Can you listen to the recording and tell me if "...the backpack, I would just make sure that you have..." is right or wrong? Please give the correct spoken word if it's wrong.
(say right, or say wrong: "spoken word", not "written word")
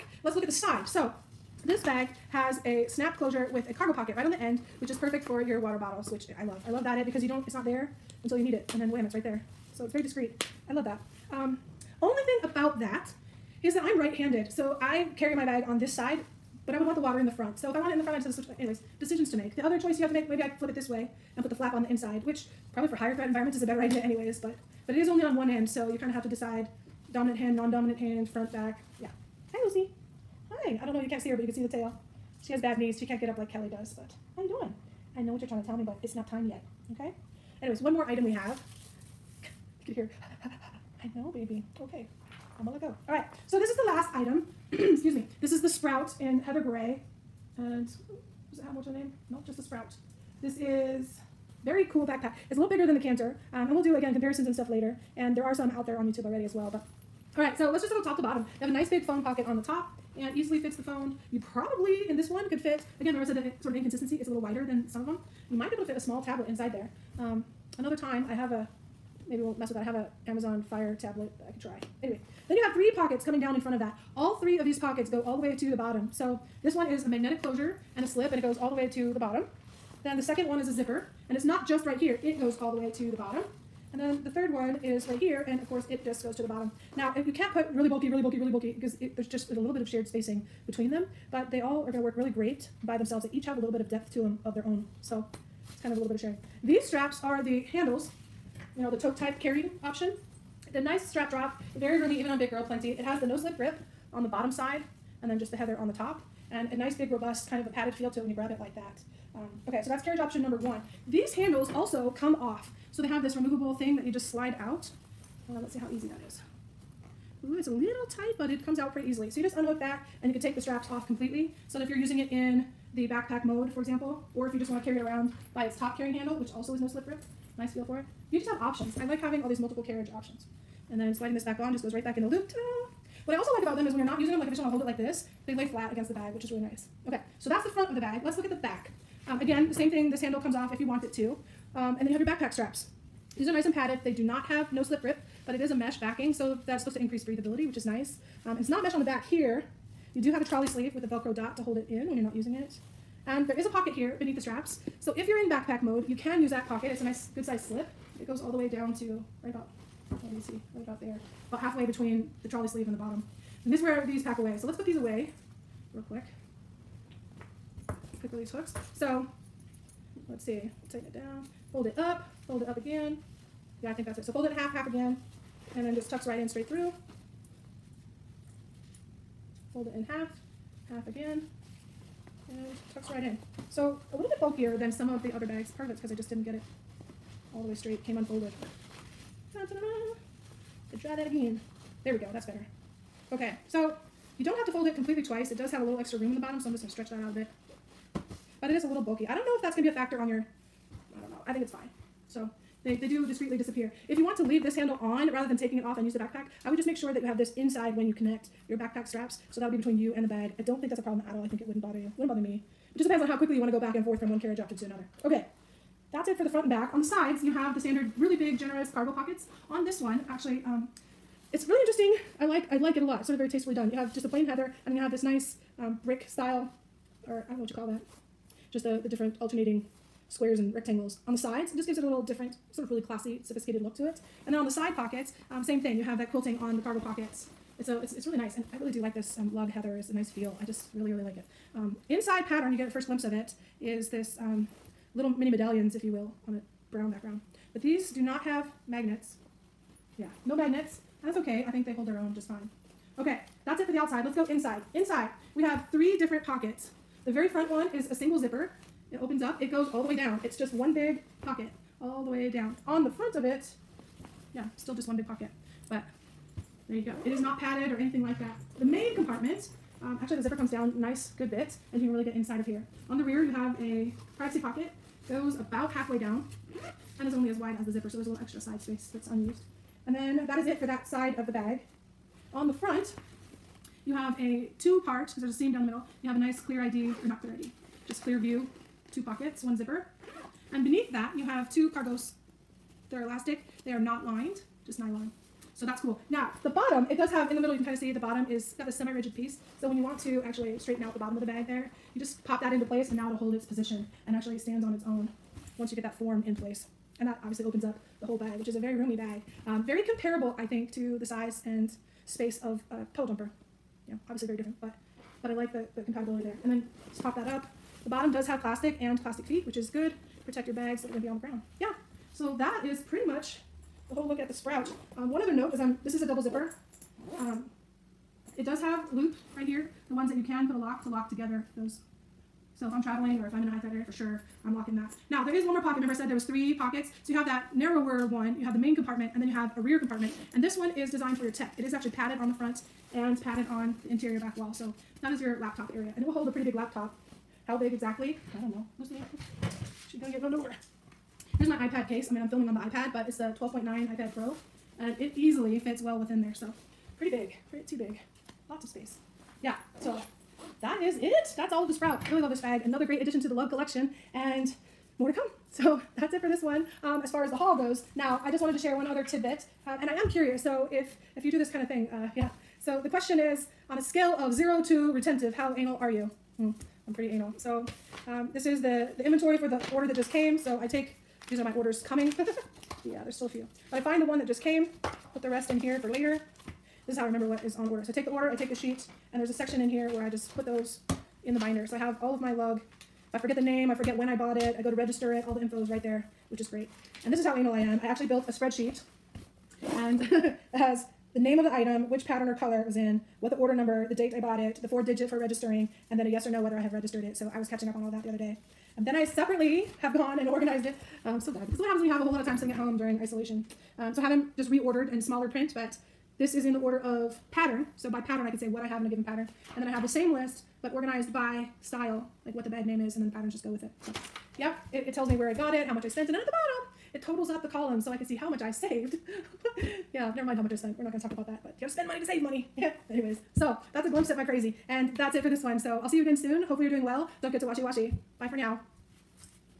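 right.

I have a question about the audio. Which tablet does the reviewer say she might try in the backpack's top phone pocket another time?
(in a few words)
Amazon Fire.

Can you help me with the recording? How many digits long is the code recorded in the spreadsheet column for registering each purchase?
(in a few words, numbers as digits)
4.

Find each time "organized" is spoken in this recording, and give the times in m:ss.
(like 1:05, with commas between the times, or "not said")
6:50, 7:00.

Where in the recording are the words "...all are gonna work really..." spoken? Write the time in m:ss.
1:31.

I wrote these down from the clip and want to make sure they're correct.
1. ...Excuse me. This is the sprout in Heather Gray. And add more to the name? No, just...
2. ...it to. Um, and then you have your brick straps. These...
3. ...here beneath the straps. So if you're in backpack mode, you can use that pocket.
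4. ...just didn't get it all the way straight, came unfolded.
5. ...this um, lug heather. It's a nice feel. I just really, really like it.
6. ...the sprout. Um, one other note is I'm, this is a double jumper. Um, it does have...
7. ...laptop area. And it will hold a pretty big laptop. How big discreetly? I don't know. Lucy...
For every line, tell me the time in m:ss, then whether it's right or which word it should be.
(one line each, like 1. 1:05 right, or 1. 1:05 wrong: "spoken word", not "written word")
1. 0:44 right
2. 2:21 wrong: "backpack", not "brick"
3. 2:33 right
4. 3:06 right
5. 3:59 right
6. 5:24 wrong: "zipper", not "jumper"
7. 5:45 wrong: "exactly", not "discreetly".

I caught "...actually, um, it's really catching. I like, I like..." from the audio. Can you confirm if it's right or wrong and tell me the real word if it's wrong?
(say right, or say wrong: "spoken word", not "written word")
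wrong: "interesting", not "catching".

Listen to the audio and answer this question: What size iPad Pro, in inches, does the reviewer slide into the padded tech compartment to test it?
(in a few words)
12.9.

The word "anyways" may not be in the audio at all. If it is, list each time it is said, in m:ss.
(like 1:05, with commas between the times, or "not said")
0:18, 0:23, 0:37, 1:12, 7:13.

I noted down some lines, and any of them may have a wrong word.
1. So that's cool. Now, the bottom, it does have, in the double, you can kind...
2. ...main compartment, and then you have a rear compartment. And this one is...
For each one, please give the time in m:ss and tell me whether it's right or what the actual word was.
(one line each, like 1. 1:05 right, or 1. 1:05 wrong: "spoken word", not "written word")
1. 4:55 wrong: "middle", not "double"
2. 5:38 right.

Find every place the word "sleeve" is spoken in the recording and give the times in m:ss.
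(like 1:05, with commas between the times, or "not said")
2:30, 2:42.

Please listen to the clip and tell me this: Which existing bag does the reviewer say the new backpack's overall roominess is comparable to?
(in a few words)
Puddle Jumper.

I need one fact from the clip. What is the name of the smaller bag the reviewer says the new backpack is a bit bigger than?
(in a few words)
Canter.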